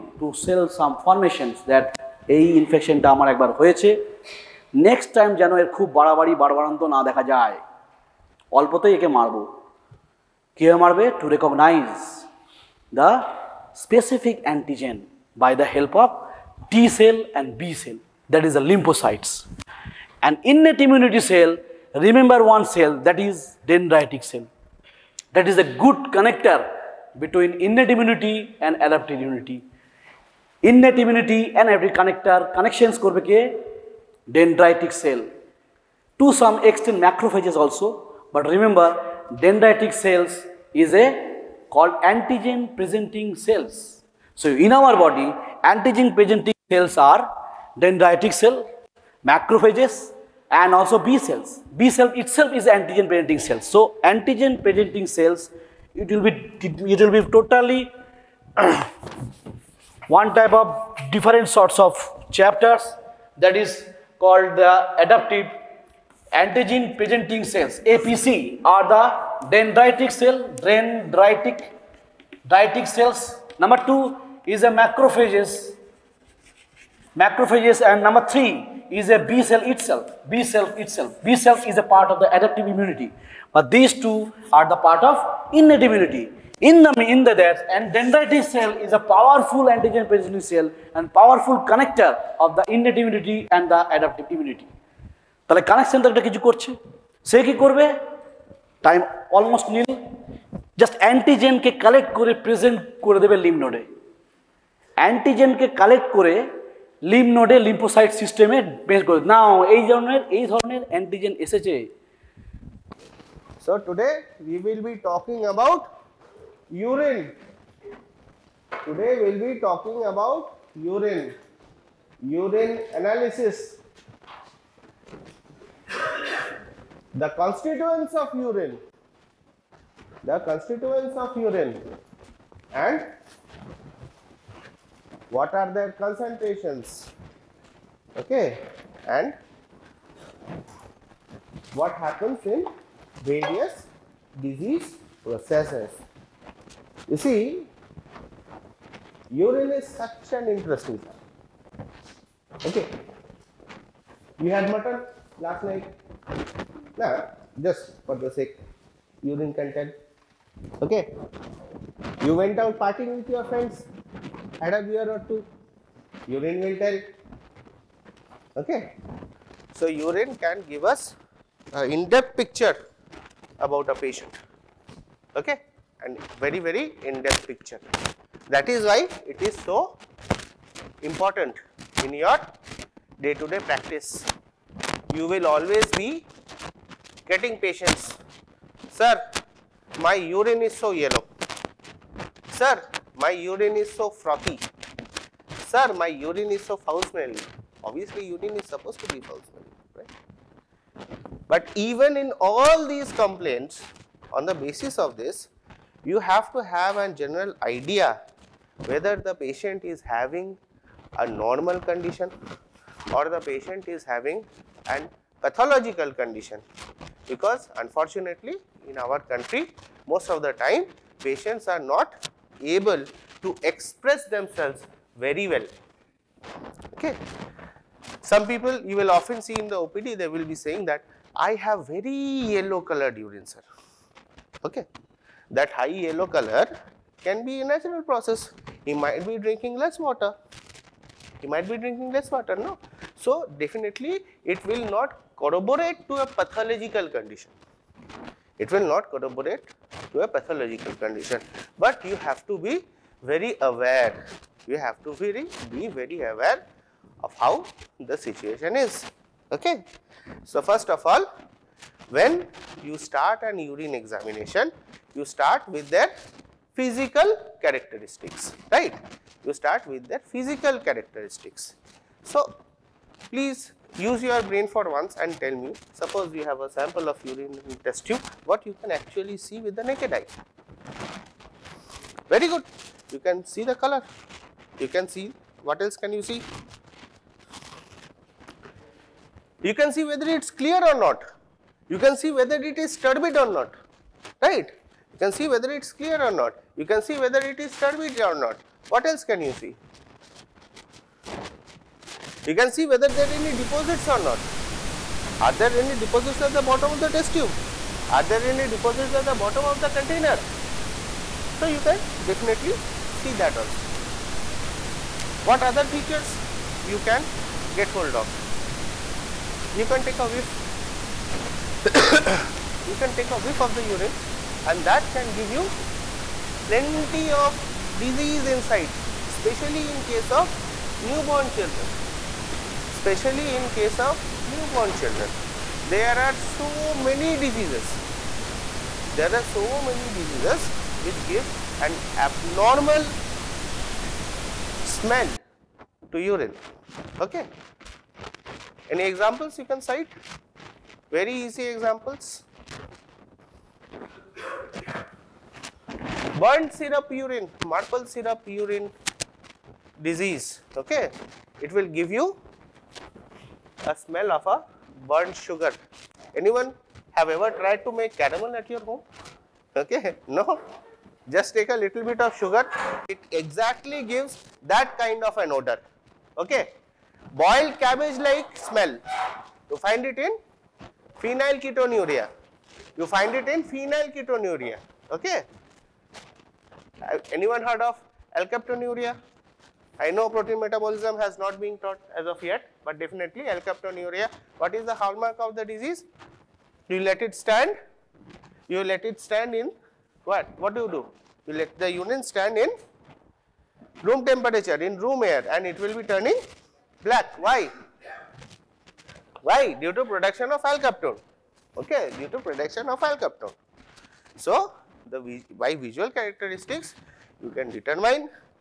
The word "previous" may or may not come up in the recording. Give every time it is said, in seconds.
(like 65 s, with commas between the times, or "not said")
not said.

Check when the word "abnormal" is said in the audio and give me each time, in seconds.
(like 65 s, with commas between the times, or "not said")
342 s.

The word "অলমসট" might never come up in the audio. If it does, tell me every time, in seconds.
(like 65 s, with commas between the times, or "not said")
99 s.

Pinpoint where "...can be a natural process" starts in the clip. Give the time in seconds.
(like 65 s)
237 s.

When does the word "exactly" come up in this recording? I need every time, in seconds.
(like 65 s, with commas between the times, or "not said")
373 s.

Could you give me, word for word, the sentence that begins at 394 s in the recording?
What is the hallmark of the disease?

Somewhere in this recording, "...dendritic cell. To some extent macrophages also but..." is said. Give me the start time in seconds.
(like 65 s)
34 s.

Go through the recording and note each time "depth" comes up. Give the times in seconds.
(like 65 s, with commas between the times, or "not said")
171 s, 177 s.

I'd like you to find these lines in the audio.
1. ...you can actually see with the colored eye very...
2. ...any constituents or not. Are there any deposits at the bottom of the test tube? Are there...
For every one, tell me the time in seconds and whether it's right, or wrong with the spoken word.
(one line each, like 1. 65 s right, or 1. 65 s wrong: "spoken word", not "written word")
1. 278 s wrong: "naked", not "colored"
2. 303 s wrong: "deposits", not "constituents".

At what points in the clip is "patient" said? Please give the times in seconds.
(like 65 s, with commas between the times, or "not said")
173 s, 187 s, 209 s, 213 s, 221 s.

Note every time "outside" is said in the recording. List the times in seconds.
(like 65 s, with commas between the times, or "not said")
not said.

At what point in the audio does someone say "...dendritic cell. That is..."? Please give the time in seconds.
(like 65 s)
23 s.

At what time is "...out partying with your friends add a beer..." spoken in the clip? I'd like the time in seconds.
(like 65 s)
162 s.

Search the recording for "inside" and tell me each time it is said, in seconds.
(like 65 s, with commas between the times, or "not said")
328 s.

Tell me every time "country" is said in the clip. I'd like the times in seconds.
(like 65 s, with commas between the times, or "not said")
219 s.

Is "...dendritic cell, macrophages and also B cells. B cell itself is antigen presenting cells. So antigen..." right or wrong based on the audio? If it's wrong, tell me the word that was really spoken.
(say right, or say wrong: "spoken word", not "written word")
right.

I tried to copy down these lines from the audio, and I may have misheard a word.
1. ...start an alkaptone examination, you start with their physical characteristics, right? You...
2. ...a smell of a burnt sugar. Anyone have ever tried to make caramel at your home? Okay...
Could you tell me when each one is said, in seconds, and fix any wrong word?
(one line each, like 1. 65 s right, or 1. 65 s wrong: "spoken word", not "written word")
1. 262 s wrong: "urine", not "alkaptone"
2. 363 s right.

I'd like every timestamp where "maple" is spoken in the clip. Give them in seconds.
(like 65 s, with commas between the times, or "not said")
357 s.